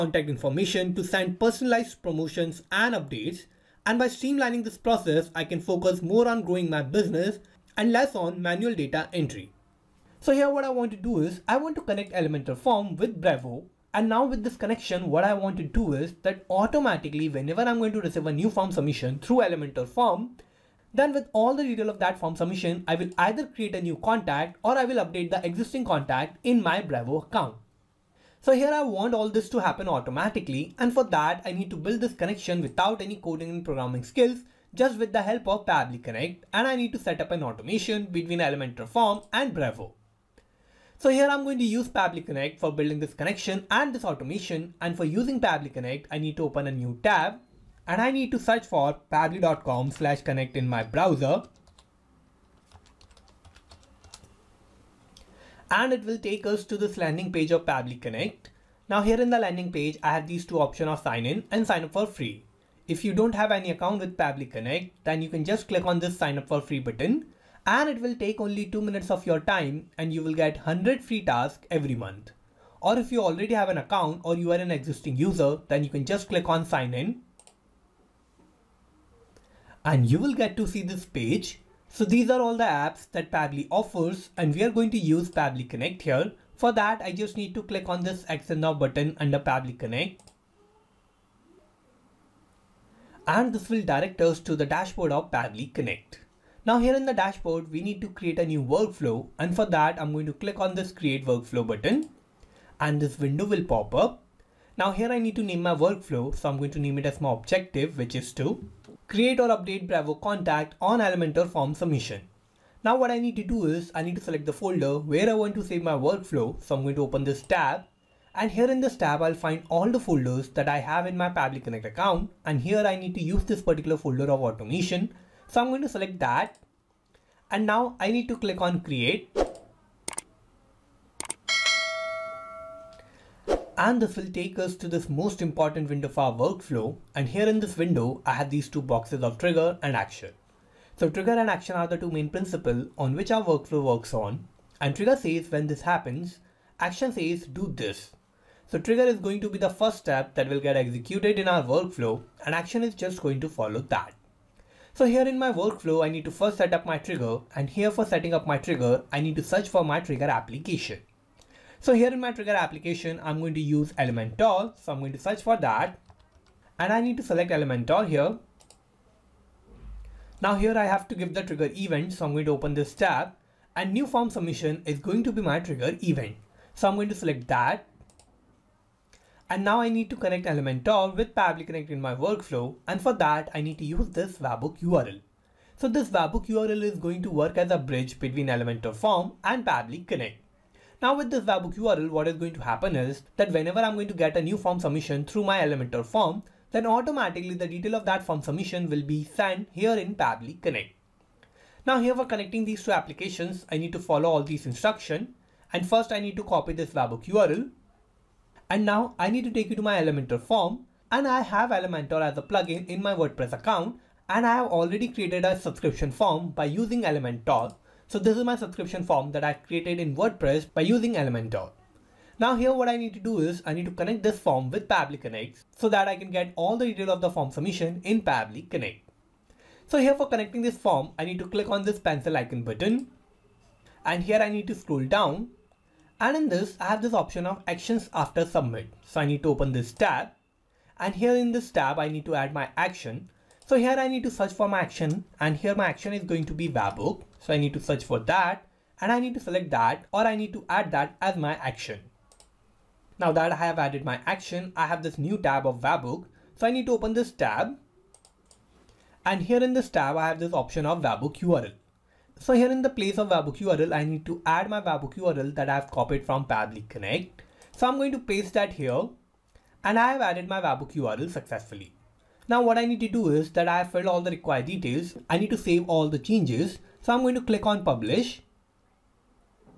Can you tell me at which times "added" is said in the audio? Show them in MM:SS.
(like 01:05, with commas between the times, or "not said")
04:13, 04:30.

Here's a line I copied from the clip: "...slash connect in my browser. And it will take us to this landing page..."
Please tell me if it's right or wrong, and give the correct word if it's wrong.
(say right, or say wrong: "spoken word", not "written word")
right.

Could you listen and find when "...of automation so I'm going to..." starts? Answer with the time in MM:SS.
02:04.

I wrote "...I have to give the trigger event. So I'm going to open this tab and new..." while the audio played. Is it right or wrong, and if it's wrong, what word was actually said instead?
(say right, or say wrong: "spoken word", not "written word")
right.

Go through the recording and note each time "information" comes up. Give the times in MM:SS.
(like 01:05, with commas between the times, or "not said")
00:00.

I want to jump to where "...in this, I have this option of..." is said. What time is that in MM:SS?
03:56.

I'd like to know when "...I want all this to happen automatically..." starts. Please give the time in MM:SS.
00:28.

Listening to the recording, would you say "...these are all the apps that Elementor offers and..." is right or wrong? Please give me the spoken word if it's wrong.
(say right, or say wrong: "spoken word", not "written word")
wrong: "Pabbly", not "Elementor".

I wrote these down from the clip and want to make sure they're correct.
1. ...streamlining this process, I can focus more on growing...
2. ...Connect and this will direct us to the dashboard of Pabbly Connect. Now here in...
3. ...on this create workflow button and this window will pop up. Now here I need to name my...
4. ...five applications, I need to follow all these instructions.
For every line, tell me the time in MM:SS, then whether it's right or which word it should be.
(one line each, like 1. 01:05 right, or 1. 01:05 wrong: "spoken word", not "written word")
1. 00:04 right
2. 01:29 right
3. 01:40 right
4. 03:22 wrong: "two", not "five".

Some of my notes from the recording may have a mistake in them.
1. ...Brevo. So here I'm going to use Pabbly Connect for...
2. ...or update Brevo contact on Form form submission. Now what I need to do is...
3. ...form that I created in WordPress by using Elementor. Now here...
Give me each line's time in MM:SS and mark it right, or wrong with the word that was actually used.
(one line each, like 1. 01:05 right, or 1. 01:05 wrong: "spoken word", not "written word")
1. 00:39 right
2. 01:49 wrong: "Elementor", not "Form"
3. 03:39 right.